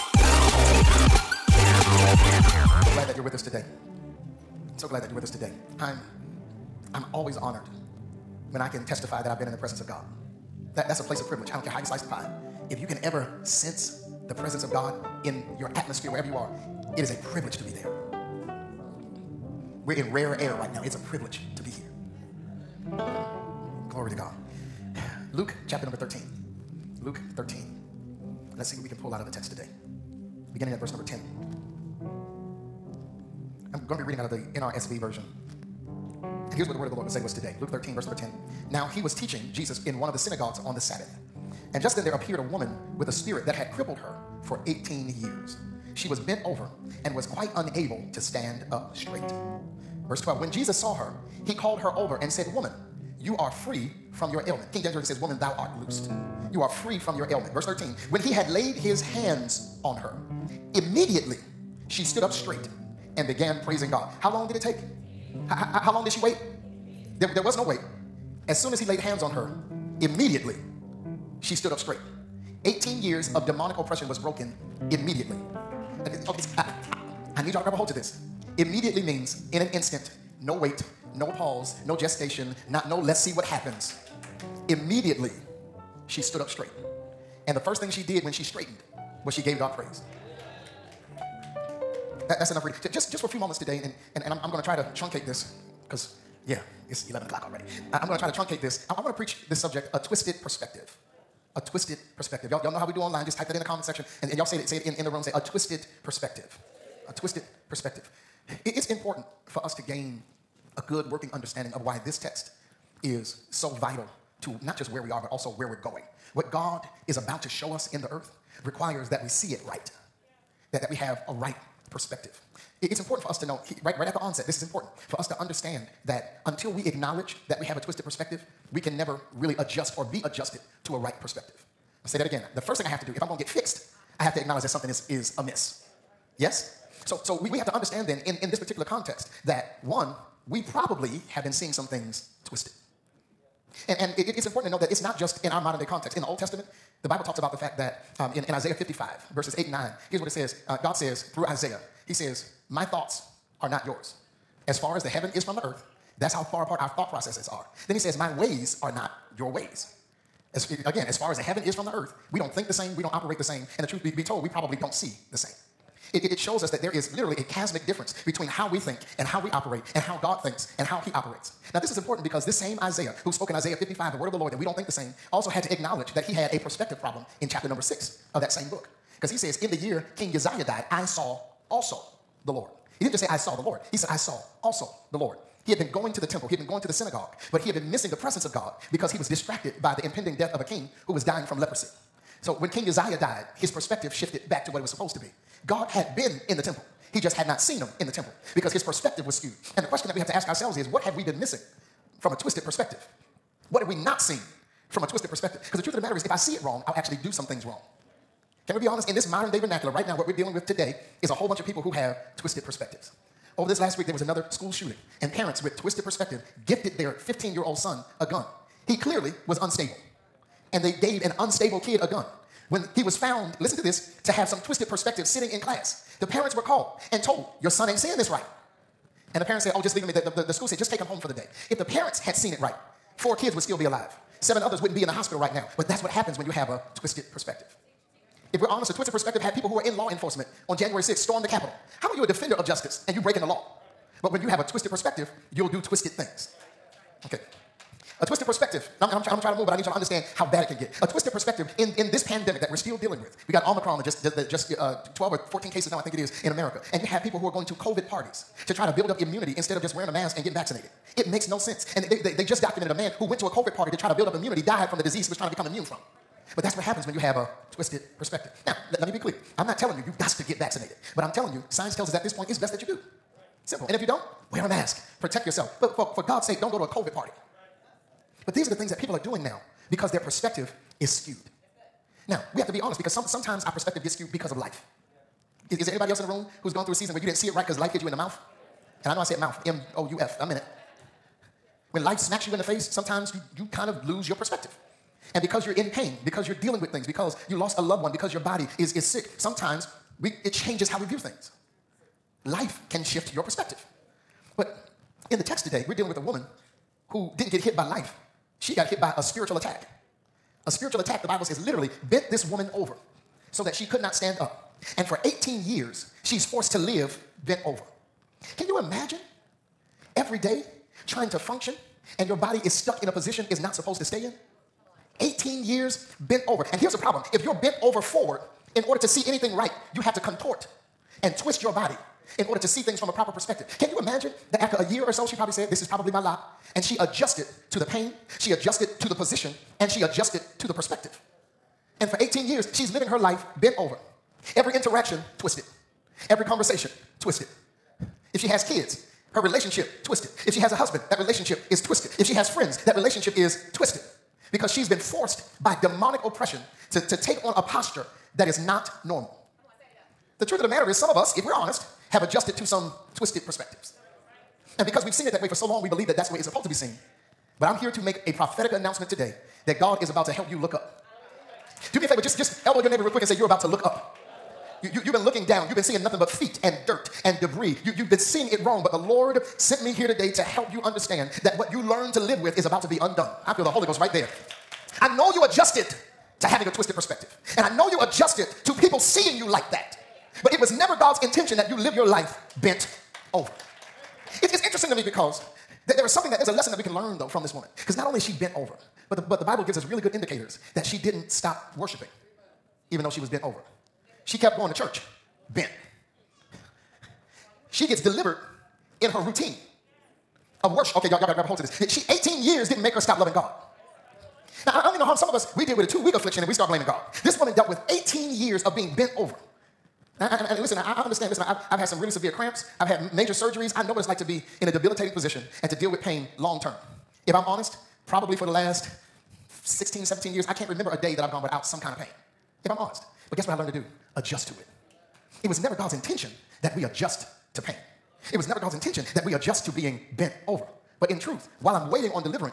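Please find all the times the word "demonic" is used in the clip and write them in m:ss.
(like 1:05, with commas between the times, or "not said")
1:13, 5:55.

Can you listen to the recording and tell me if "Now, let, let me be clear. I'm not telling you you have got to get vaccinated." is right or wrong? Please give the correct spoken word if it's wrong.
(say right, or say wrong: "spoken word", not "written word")
right.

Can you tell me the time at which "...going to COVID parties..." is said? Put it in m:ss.
4:17.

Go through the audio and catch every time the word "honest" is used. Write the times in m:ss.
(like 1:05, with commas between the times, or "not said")
3:28, 3:58, 4:42, 6:01, 7:07, 7:12.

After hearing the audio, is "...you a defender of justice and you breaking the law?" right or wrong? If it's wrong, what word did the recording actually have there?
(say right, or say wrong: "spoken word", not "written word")
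right.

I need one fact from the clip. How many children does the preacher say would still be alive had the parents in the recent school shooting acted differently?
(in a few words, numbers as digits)
4.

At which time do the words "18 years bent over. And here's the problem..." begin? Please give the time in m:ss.
5:25.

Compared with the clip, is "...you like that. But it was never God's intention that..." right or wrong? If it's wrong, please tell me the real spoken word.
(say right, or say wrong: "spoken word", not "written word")
right.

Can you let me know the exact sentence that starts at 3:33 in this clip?
Over this last week, there was another school shooting, and parents with twisted perspective gifted their 15 year old son a gun.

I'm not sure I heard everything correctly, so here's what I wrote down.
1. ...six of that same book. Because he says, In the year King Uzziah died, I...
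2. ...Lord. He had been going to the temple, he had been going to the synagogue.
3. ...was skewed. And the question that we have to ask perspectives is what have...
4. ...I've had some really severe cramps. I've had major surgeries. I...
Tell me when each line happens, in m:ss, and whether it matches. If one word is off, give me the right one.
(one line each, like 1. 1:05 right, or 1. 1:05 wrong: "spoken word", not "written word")
1. 2:57 right
2. 3:05 right
3. 3:19 wrong: "ourselves", not "perspectives"
4. 7:01 right.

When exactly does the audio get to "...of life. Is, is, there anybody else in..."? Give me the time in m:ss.
4:44.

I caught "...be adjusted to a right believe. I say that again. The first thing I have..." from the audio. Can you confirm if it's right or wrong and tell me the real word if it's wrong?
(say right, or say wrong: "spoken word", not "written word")
wrong: "perspective", not "believe".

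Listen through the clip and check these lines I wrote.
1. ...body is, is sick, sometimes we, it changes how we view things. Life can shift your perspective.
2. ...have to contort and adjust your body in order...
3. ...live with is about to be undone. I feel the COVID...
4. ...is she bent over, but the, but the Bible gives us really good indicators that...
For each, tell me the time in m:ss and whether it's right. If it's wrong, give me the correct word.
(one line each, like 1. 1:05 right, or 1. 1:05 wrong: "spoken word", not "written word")
1. 4:58 right
2. 5:29 wrong: "twist", not "adjust"
3. 6:22 wrong: "Holy", not "COVID"
4. 6:38 right.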